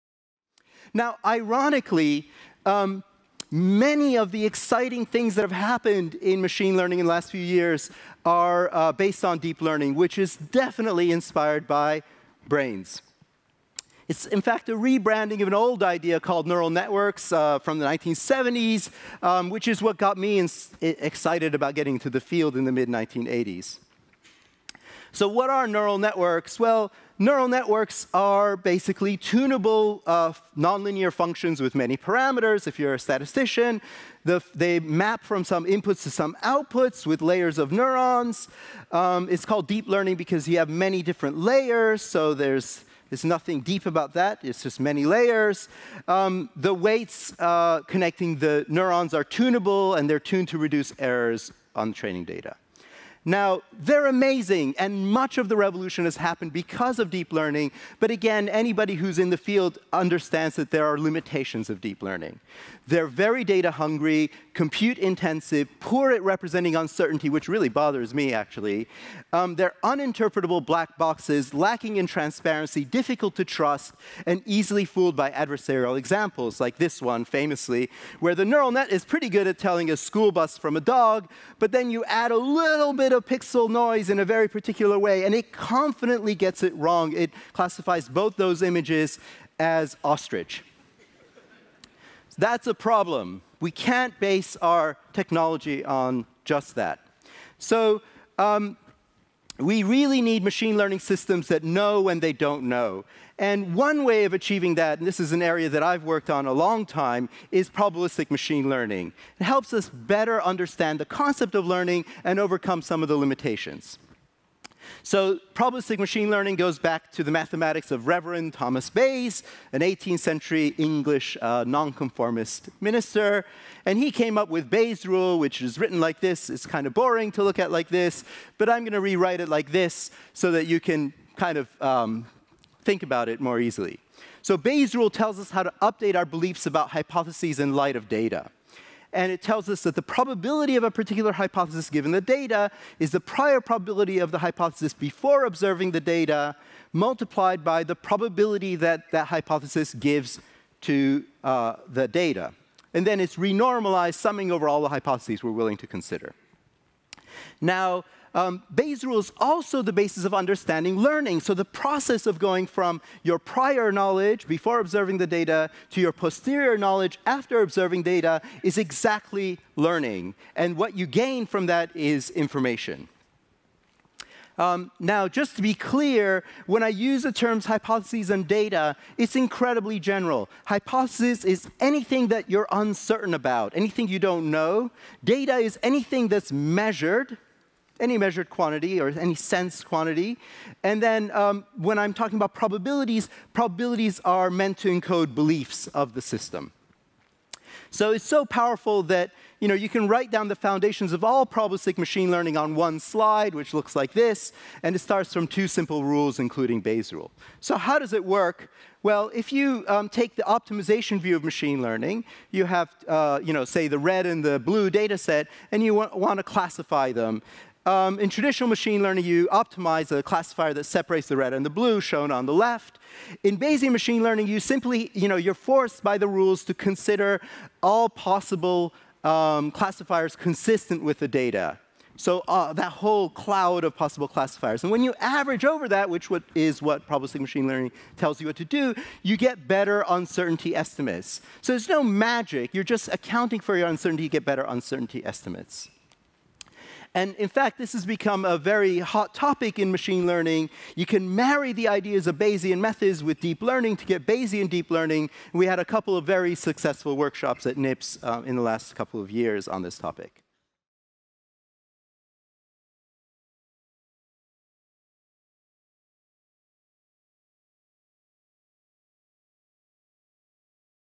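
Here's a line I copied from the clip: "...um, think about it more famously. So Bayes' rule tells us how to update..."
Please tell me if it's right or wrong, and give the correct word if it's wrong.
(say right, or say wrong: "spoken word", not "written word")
wrong: "easily", not "famously".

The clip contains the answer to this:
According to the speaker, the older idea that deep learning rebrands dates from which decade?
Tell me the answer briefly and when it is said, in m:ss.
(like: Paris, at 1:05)
1970s, at 0:17.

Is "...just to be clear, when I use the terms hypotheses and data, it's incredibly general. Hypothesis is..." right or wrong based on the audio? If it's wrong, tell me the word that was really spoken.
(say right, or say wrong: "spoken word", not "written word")
right.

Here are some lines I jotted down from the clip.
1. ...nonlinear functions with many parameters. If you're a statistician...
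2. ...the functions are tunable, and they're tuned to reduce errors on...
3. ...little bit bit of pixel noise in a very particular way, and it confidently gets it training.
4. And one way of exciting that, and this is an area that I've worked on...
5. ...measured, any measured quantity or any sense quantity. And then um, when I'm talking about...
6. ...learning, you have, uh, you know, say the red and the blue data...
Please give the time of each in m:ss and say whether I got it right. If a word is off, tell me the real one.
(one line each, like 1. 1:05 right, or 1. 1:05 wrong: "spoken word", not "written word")
1. 0:30 right
2. 0:48 wrong: "neurons", not "functions"
3. 1:22 wrong: "wrong", not "training"
4. 1:43 wrong: "achieving", not "exciting"
5. 3:06 right
6. 3:31 right.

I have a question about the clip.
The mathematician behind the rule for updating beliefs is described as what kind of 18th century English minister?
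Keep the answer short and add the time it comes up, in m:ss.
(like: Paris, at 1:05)
nonconformist, at 2:01.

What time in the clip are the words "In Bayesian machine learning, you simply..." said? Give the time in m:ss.
3:43.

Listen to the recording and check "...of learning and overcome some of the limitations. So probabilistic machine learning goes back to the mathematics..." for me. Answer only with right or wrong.
right.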